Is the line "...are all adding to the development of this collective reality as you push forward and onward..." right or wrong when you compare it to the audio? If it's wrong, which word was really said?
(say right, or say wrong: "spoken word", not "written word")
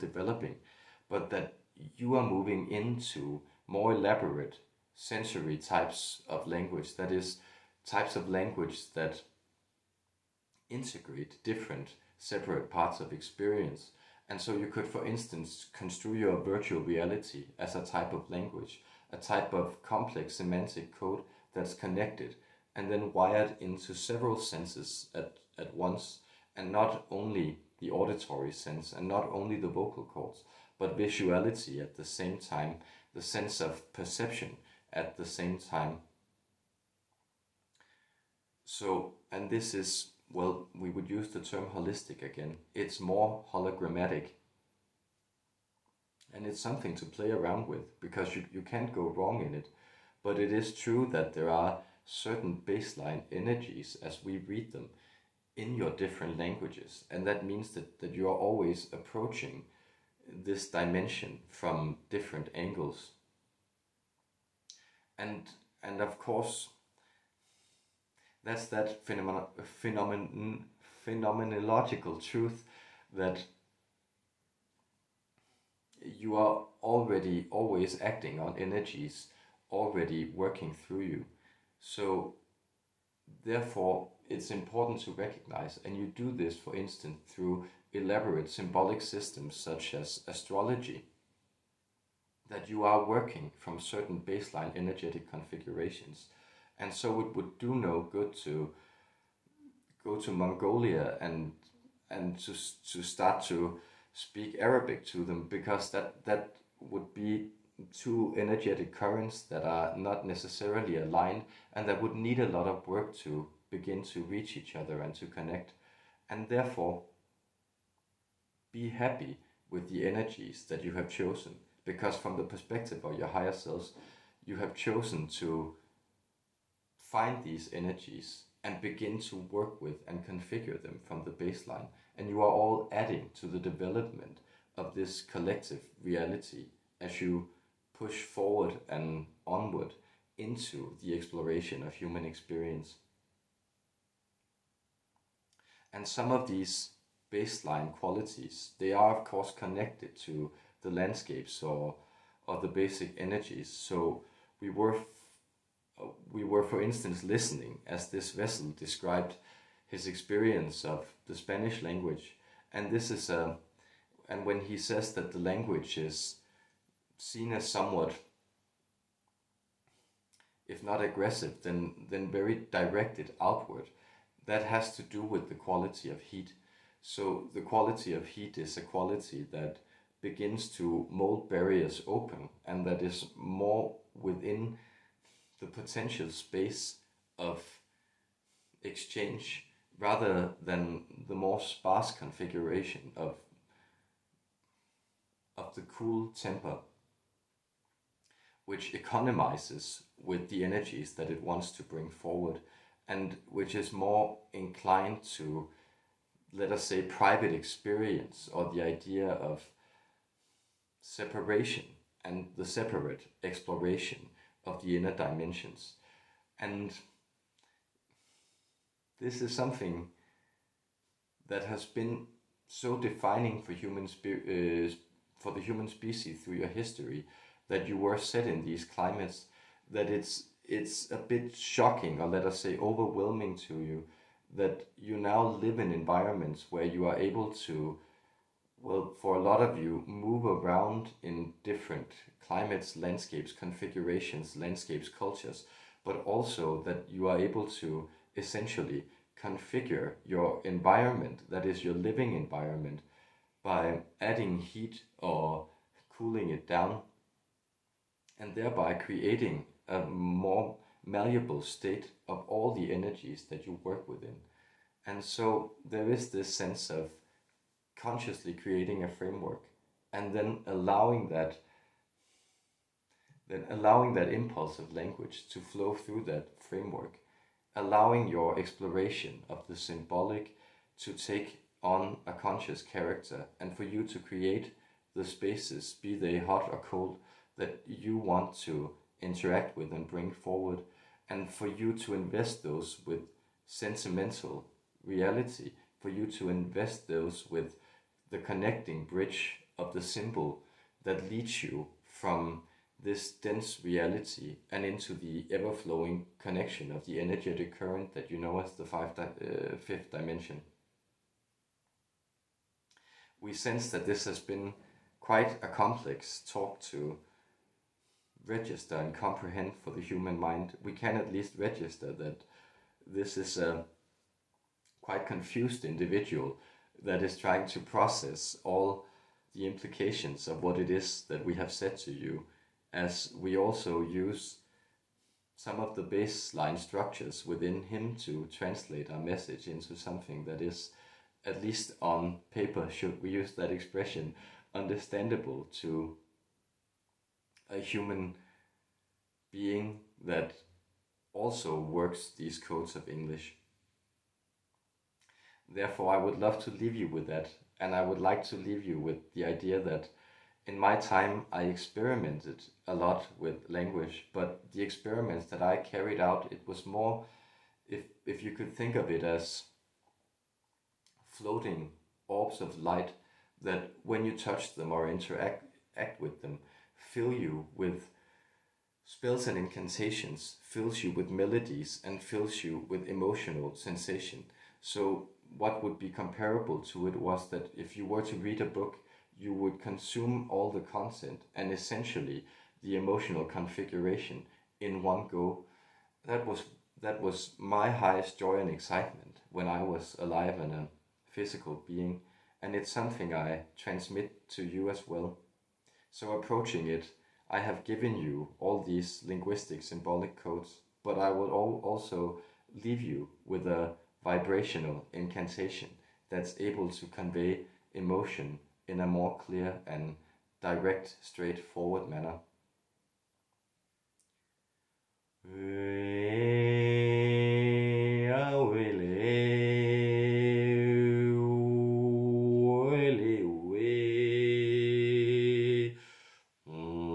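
right.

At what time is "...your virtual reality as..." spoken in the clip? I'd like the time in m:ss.
0:16.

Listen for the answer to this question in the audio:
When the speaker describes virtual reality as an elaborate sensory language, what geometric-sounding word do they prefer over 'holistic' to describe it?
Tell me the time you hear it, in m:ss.
0:43.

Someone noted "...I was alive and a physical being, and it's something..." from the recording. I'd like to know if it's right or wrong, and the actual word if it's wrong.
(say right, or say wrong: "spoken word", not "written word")
right.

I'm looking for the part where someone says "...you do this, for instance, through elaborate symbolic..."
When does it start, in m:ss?
1:25.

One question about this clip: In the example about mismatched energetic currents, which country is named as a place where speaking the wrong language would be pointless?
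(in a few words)
Mongolia.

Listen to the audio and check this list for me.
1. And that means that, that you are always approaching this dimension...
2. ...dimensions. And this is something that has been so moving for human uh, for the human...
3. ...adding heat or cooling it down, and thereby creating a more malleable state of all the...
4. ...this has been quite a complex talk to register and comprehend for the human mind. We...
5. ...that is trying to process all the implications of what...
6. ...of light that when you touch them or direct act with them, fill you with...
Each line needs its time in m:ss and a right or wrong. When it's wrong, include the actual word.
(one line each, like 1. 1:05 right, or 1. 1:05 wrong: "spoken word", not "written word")
1. 0:57 right
2. 3:35 wrong: "defining", not "moving"
3. 4:14 right
4. 5:14 right
5. 5:27 right
6. 6:12 wrong: "interact", not "direct".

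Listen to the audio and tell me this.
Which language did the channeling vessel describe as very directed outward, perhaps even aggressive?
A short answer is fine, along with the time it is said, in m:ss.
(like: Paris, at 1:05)
Spanish, at 2:41.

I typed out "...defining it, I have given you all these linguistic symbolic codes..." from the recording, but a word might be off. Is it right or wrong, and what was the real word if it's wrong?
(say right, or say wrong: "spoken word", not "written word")
wrong: "approaching", not "defining".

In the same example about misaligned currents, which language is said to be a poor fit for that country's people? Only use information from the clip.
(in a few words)
Arabic.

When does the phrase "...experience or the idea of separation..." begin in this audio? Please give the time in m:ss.
3:27.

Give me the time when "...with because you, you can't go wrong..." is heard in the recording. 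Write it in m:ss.
0:47.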